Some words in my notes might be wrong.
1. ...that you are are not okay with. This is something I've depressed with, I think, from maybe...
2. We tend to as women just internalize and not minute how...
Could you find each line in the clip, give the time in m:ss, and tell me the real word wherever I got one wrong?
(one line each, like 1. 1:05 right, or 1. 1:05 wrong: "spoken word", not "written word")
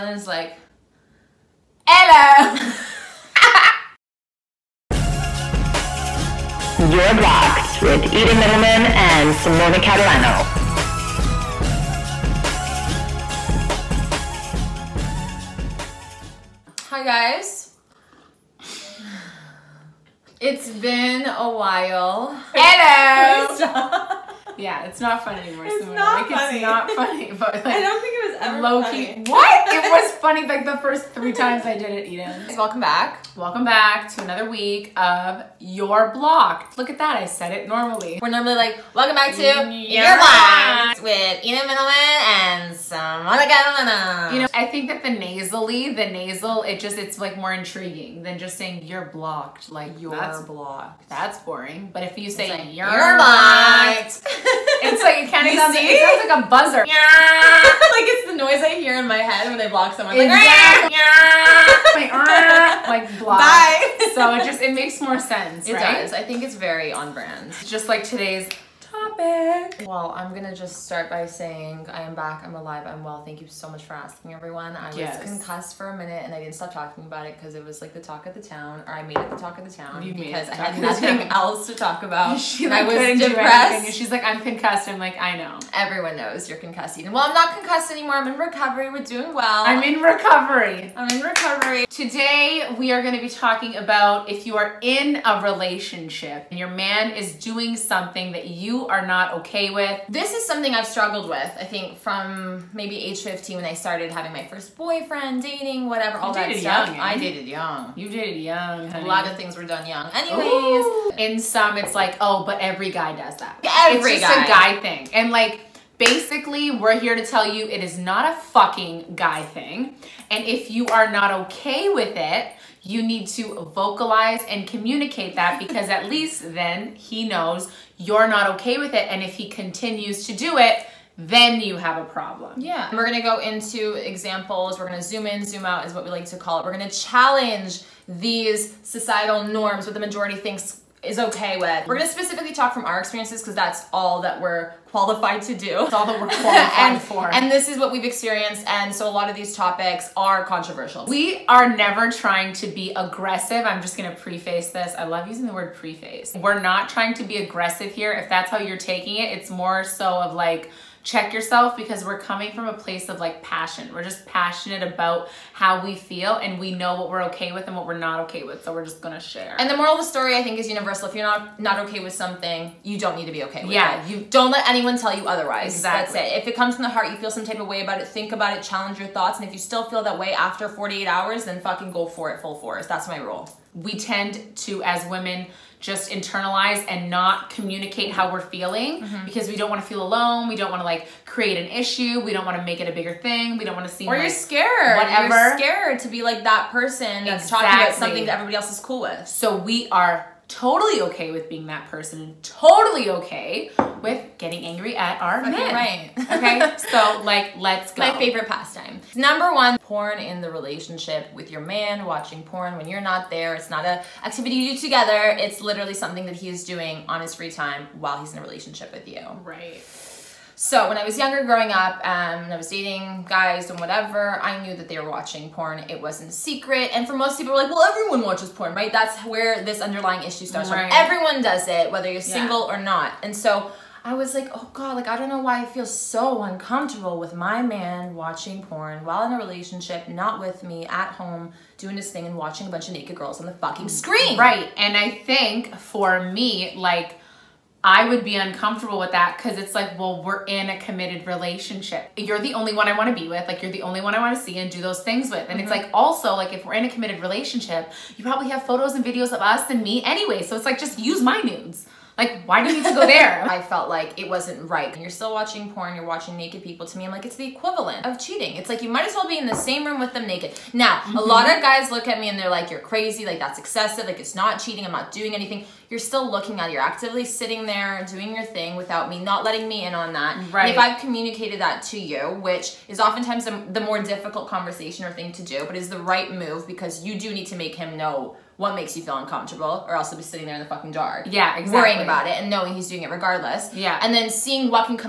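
1. 1:38 wrong: "struggled", not "depressed"
2. 3:03 wrong: "communicate", not "minute".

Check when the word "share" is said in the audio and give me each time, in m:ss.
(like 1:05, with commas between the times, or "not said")
2:49.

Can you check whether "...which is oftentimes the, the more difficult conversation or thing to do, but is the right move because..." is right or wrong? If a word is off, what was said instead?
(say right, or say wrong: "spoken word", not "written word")
right.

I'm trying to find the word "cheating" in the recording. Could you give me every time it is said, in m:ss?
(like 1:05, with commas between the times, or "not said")
4:28, 4:34.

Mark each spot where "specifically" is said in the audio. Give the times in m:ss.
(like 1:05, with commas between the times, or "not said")
2:22.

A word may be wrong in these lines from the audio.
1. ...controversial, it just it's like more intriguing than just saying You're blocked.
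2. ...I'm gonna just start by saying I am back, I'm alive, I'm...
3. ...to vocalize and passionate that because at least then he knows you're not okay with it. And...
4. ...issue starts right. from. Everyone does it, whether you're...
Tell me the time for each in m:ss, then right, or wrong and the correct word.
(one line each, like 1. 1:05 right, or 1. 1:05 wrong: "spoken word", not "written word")
1. 0:46 wrong: "nasal", not "controversial"
2. 1:10 right
3. 2:03 wrong: "communicate", not "passionate"
4. 3:50 right.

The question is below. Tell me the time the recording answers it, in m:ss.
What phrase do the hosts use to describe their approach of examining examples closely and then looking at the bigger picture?
2:15.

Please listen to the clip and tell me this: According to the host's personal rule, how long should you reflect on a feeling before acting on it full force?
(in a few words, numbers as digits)
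48 hours.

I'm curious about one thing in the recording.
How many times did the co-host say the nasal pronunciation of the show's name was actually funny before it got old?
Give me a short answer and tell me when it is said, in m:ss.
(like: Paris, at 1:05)
3, at 0:31.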